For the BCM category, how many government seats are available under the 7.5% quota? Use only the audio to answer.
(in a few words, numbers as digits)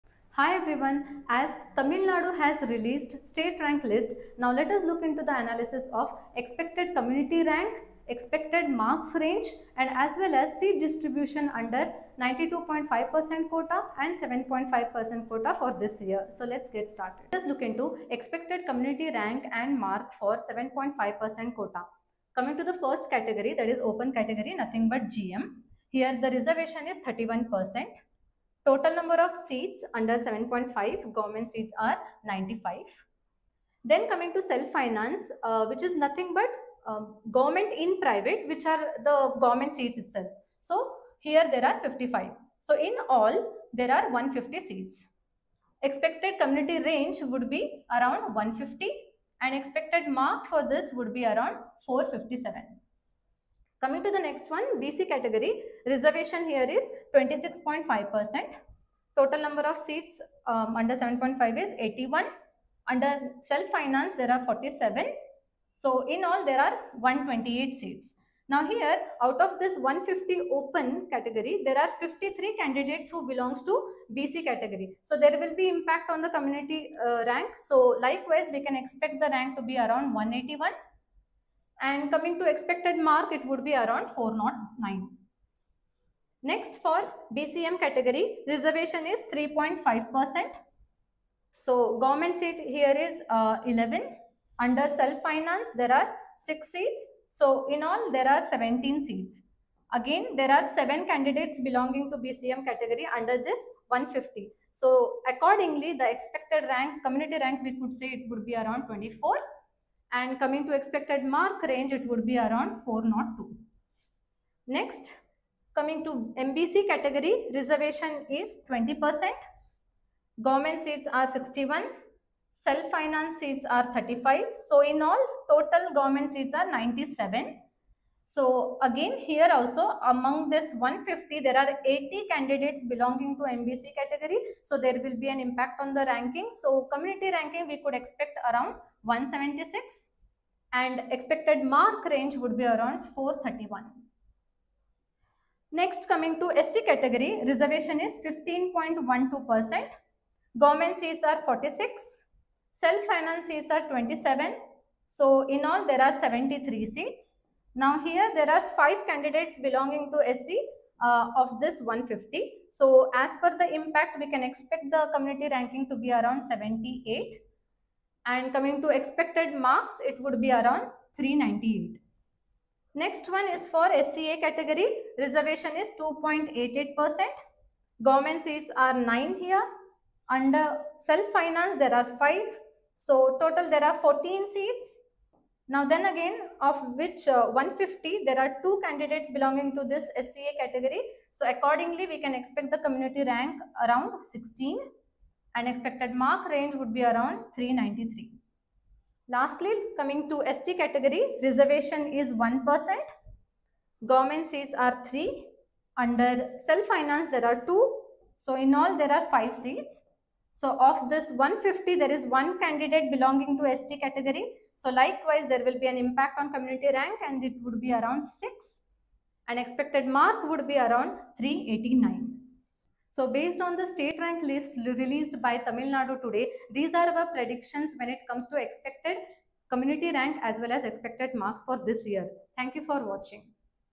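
11.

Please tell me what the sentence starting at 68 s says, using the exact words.
Now here, out of this 150 open category, there are 53 candidates who belongs to BC category.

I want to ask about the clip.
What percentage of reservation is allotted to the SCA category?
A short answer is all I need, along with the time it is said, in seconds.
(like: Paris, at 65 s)
2.88%, at 175 s.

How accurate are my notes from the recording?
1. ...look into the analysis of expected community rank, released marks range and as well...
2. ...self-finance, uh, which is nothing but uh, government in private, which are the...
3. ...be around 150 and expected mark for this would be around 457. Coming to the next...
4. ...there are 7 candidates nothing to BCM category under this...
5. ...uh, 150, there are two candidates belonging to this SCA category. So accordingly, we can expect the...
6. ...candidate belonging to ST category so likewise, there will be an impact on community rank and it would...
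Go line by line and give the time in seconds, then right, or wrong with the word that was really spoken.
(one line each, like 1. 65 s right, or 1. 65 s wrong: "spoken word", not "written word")
1. 4 s wrong: "expected", not "released"
2. 34 s right
3. 47 s right
4. 100 s wrong: "belonging", not "nothing"
5. 187 s right
6. 212 s right.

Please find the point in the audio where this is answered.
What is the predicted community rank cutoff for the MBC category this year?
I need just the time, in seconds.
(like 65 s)
139 s.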